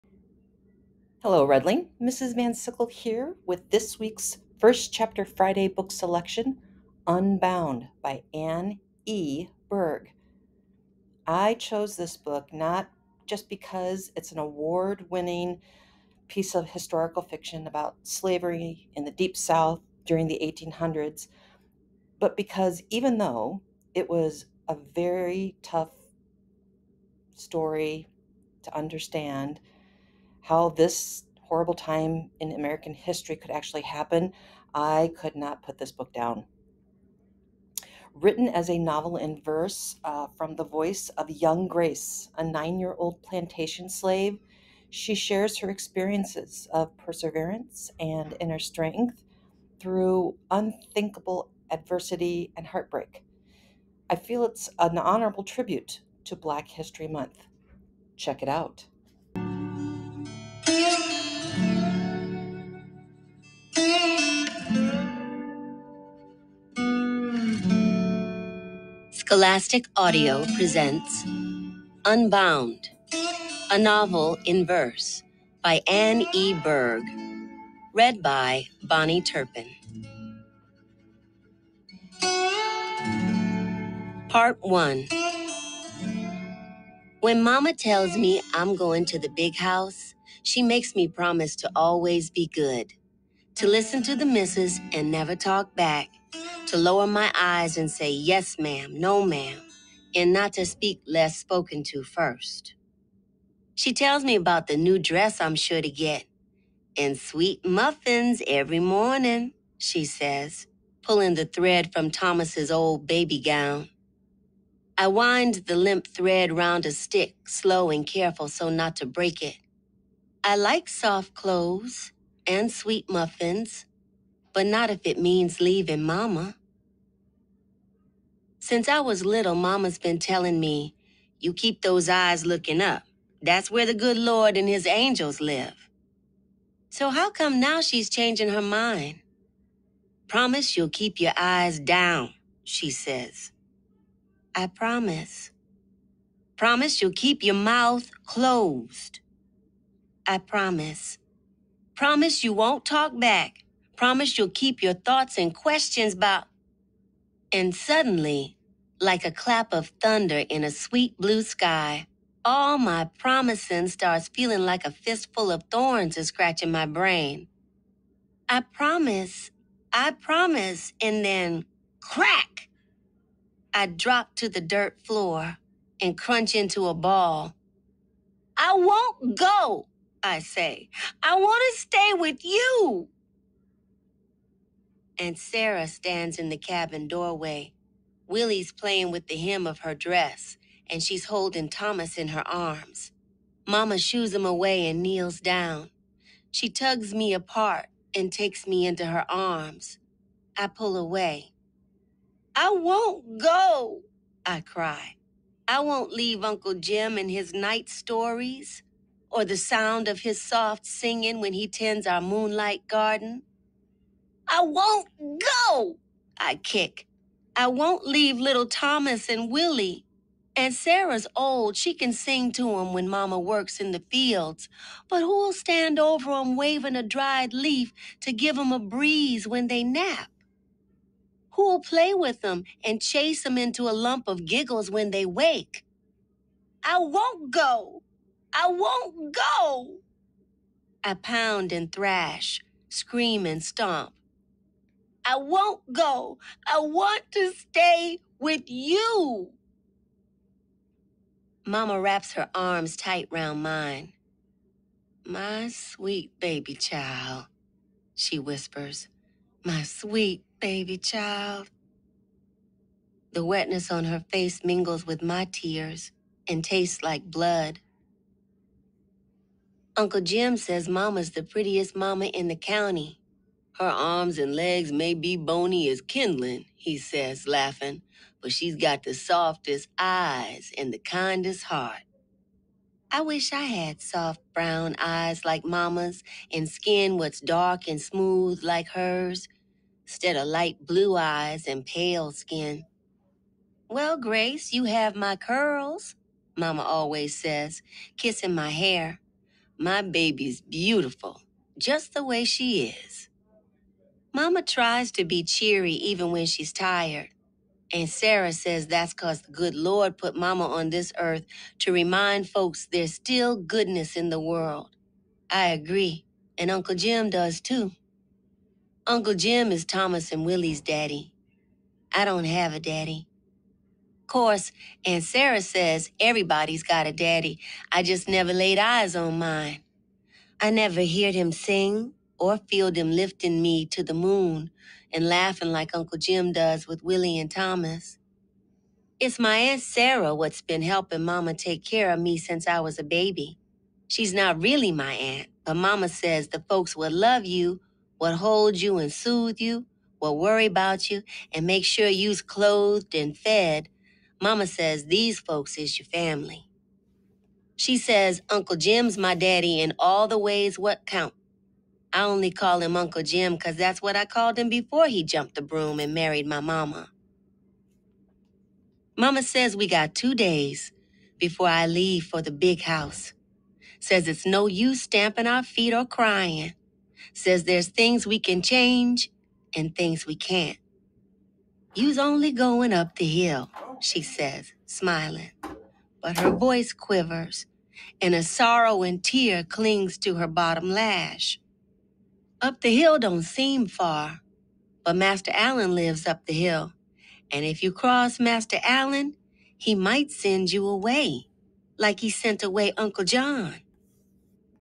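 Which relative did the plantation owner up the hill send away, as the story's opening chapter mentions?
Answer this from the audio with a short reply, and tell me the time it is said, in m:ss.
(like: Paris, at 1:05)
Uncle John, at 6:42.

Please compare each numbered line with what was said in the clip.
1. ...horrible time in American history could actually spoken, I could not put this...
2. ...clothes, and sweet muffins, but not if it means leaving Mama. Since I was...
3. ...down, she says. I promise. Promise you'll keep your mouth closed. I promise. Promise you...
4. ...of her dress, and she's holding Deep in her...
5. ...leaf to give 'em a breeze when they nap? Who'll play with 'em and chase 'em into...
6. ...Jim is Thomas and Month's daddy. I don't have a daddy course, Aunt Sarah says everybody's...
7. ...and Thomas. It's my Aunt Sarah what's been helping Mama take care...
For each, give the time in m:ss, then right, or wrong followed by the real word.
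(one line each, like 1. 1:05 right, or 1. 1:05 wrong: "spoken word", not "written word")
1. 0:31 wrong: "happen", not "spoken"
2. 2:01 right
3. 2:21 right
4. 3:09 wrong: "Thomas", not "Deep"
5. 3:47 right
6. 5:19 wrong: "Willie", not "Month"
7. 5:37 right.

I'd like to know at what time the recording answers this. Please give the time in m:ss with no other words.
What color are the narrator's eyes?
4:50.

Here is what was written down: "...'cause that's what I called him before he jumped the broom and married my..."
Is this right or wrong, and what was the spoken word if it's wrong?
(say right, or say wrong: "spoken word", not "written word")
right.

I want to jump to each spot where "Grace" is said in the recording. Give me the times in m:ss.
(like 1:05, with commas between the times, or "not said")
0:41, 4:54.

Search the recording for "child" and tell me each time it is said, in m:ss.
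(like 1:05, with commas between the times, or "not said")
4:16, 4:20.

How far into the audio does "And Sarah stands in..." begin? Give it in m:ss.
3:05.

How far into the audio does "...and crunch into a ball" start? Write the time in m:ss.
2:56.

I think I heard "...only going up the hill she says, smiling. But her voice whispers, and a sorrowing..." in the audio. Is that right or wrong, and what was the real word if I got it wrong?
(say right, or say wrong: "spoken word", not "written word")
wrong: "quivers", not "whispers".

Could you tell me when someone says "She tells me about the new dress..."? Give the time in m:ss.
1:43.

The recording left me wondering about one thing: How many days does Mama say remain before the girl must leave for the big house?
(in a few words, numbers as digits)
2.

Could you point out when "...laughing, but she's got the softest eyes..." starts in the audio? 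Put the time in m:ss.
4:37.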